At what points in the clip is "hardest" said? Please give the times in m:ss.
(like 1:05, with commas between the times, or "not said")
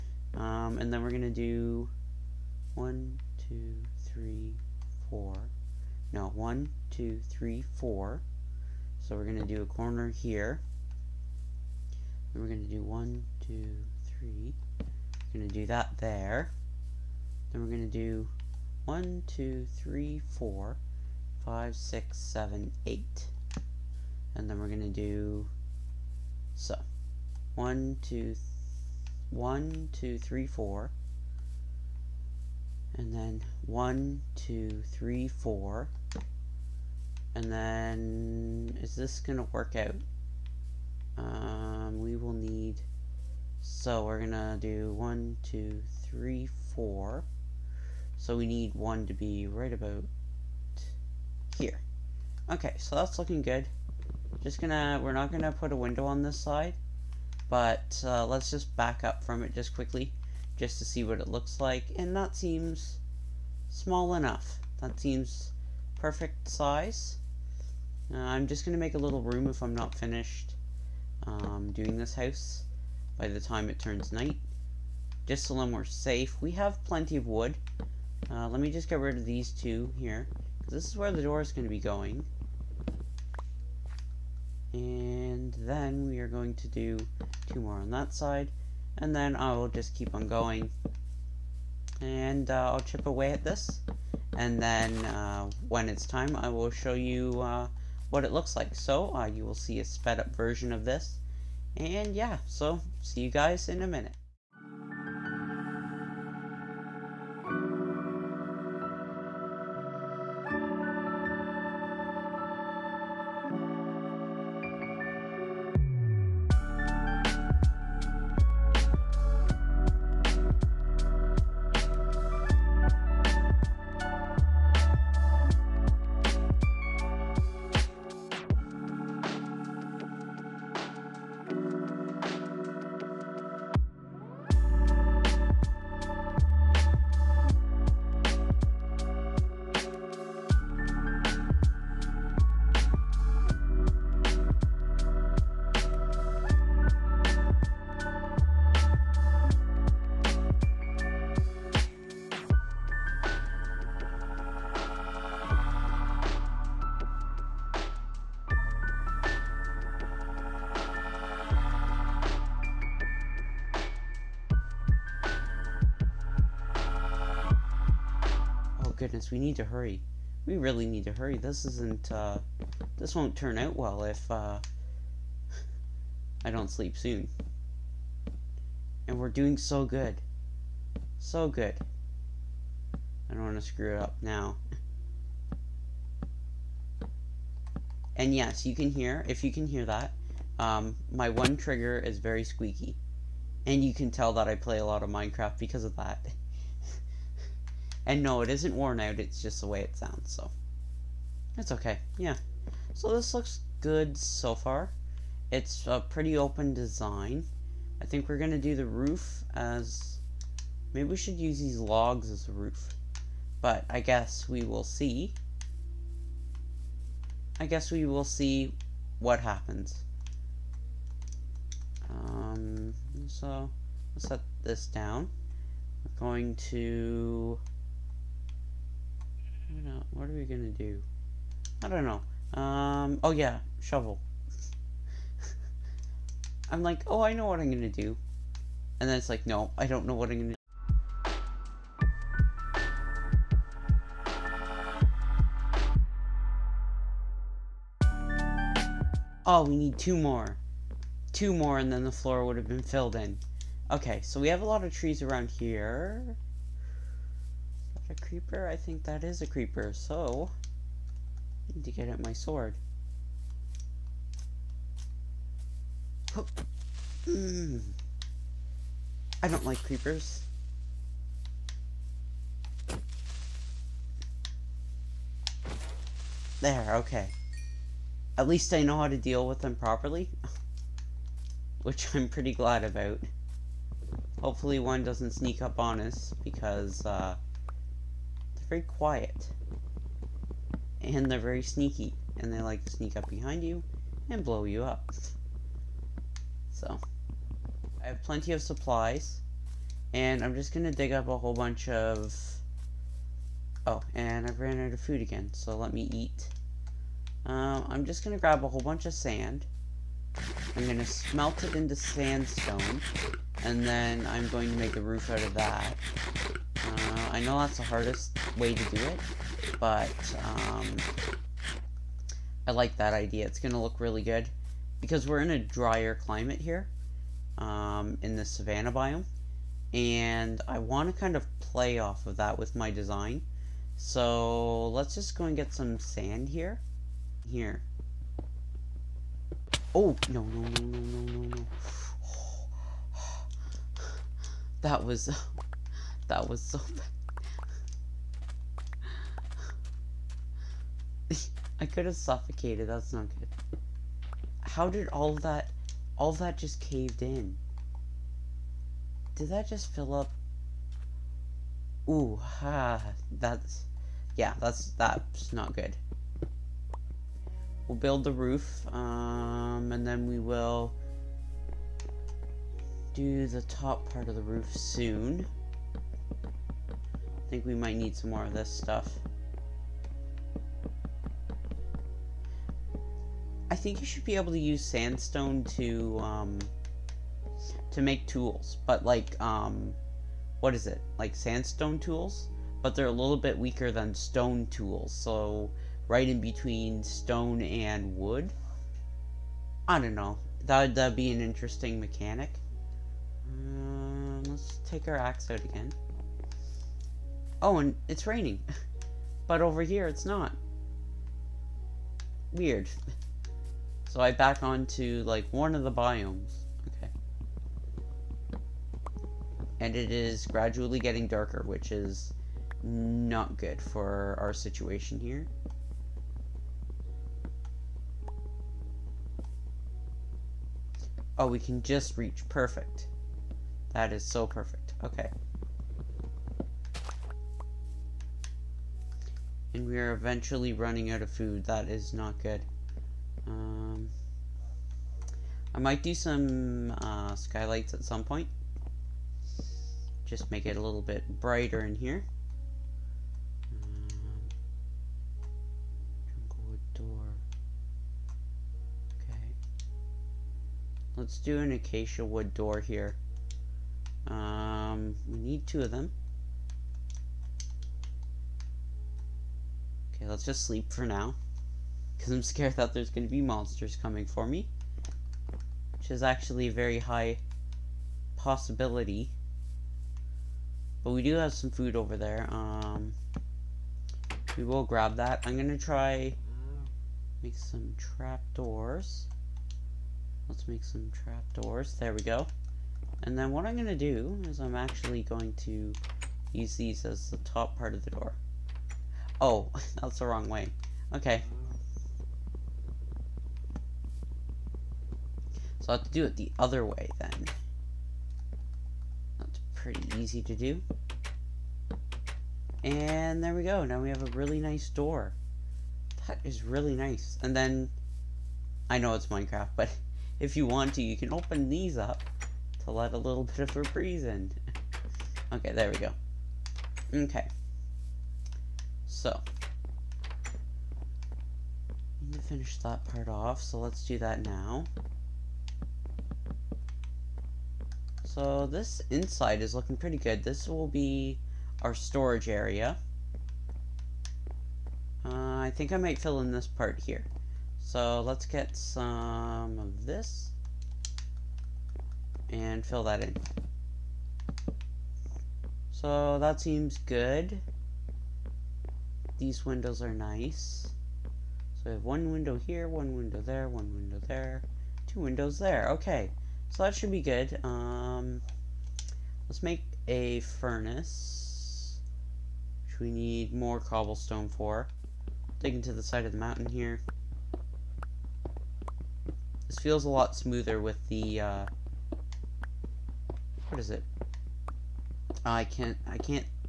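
5:17.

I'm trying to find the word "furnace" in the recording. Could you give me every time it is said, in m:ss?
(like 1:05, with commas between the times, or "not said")
9:30.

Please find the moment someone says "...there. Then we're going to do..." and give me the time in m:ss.
0:15.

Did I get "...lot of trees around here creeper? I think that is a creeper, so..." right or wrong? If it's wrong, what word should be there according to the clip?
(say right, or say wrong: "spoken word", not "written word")
right.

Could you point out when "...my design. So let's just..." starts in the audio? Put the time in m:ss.
5:32.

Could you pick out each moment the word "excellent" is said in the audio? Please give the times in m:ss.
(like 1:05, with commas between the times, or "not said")
not said.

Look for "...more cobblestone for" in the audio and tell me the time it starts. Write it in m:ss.
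9:33.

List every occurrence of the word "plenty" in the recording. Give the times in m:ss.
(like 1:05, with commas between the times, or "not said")
1:16, 4:58.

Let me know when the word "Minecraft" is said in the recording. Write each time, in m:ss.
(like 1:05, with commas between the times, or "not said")
3:15, 8:39.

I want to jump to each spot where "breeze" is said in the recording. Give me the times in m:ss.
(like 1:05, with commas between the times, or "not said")
8:43.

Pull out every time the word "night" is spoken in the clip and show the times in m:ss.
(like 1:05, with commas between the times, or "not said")
1:14.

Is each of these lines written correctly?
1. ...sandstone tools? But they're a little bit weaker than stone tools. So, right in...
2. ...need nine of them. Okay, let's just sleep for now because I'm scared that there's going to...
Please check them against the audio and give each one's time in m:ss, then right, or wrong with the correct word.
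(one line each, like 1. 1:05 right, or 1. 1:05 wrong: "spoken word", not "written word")
1. 6:31 right
2. 7:45 wrong: "two", not "nine".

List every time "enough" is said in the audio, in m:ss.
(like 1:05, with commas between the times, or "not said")
1:04.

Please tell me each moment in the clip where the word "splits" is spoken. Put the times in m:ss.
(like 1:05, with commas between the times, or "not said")
not said.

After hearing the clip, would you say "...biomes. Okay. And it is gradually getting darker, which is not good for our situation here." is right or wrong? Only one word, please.
right.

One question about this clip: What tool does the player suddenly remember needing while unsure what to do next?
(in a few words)
Shovel.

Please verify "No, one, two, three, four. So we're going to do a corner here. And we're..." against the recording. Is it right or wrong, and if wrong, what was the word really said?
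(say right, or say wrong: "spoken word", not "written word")
right.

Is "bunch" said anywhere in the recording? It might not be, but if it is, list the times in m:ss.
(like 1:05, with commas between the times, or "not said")
5:01, 5:08.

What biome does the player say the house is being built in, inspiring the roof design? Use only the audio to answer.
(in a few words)
Savanna.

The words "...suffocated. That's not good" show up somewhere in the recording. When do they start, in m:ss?
5:52.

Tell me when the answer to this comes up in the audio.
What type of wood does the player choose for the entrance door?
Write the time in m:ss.
7:41.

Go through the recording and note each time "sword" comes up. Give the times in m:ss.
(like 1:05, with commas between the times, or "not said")
4:22.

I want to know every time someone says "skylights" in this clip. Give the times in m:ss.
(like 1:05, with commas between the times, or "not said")
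7:27.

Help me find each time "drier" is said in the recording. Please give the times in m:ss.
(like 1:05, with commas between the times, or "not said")
5:25.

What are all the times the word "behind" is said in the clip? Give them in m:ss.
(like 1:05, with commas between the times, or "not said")
4:53.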